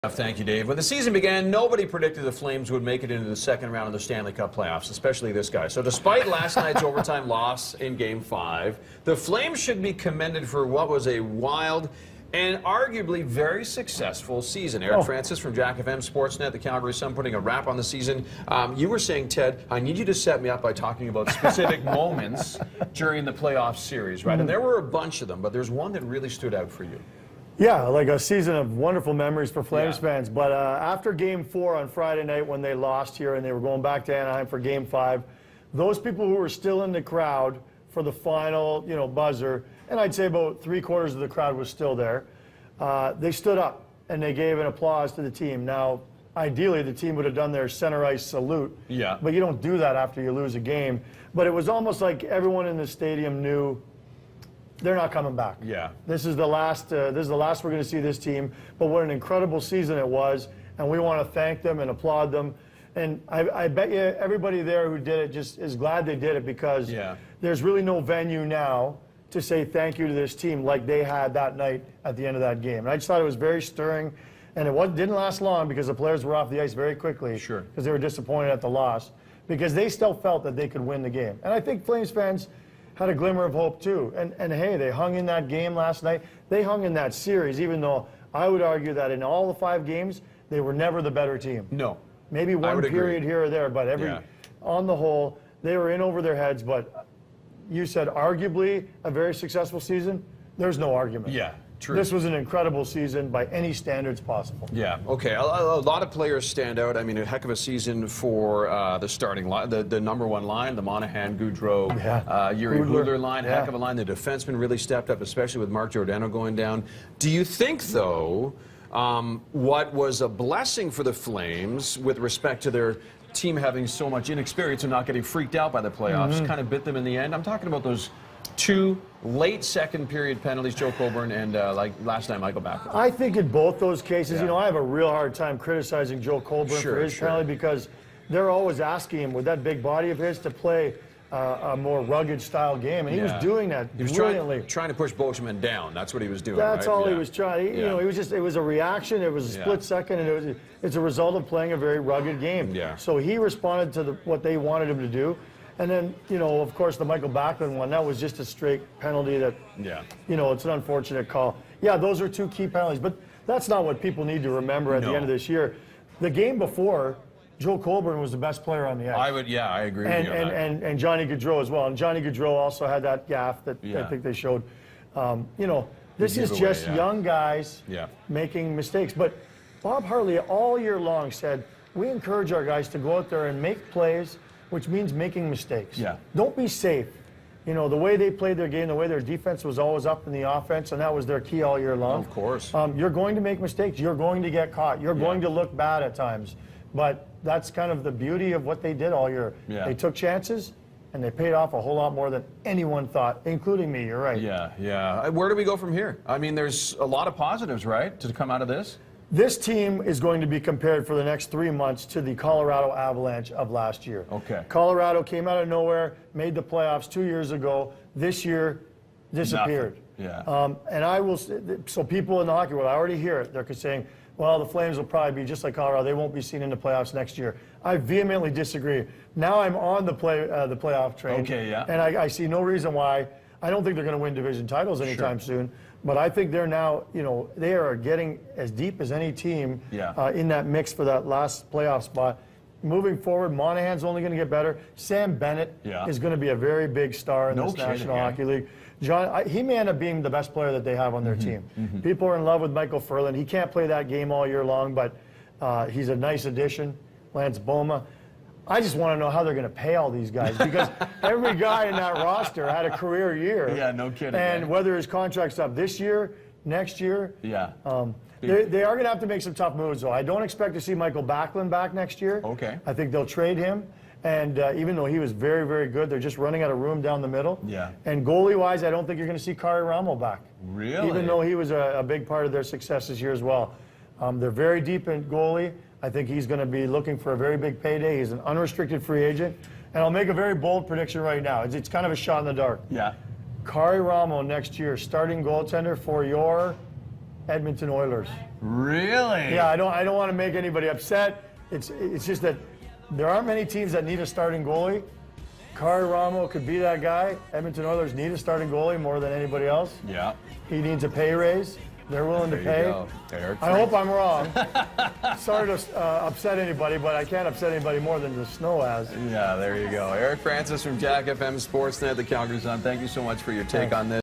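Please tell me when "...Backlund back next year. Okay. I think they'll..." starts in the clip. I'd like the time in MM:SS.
04:31.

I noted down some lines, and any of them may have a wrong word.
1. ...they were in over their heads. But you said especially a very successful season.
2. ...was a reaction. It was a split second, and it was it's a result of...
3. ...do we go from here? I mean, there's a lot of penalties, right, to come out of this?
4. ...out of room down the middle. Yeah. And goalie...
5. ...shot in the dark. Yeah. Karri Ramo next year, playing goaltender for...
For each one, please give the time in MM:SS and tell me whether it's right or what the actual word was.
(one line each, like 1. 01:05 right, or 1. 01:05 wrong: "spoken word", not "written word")
1. 01:35 wrong: "arguably", not "especially"
2. 02:28 right
3. 03:25 wrong: "positives", not "penalties"
4. 04:36 right
5. 04:52 wrong: "starting", not "playing".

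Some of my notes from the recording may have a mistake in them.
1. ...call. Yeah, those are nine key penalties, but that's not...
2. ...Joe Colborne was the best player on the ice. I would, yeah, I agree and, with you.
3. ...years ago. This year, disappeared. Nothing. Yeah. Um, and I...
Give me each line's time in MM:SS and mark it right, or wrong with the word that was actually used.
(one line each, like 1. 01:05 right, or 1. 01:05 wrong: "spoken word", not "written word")
1. 02:41 wrong: "two", not "nine"
2. 02:47 right
3. 03:37 right.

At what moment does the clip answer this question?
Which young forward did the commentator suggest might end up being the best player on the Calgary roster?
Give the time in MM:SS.
04:04.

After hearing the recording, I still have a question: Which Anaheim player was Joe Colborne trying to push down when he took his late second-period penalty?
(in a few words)
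Beauchemin.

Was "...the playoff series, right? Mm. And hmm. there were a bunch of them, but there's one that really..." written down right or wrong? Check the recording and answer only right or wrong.
right.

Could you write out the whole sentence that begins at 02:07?
I'm talking about those two late second period penalties, Joe Colborne and uh, like last night, Michael Backer.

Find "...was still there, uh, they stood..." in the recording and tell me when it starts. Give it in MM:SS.
00:41.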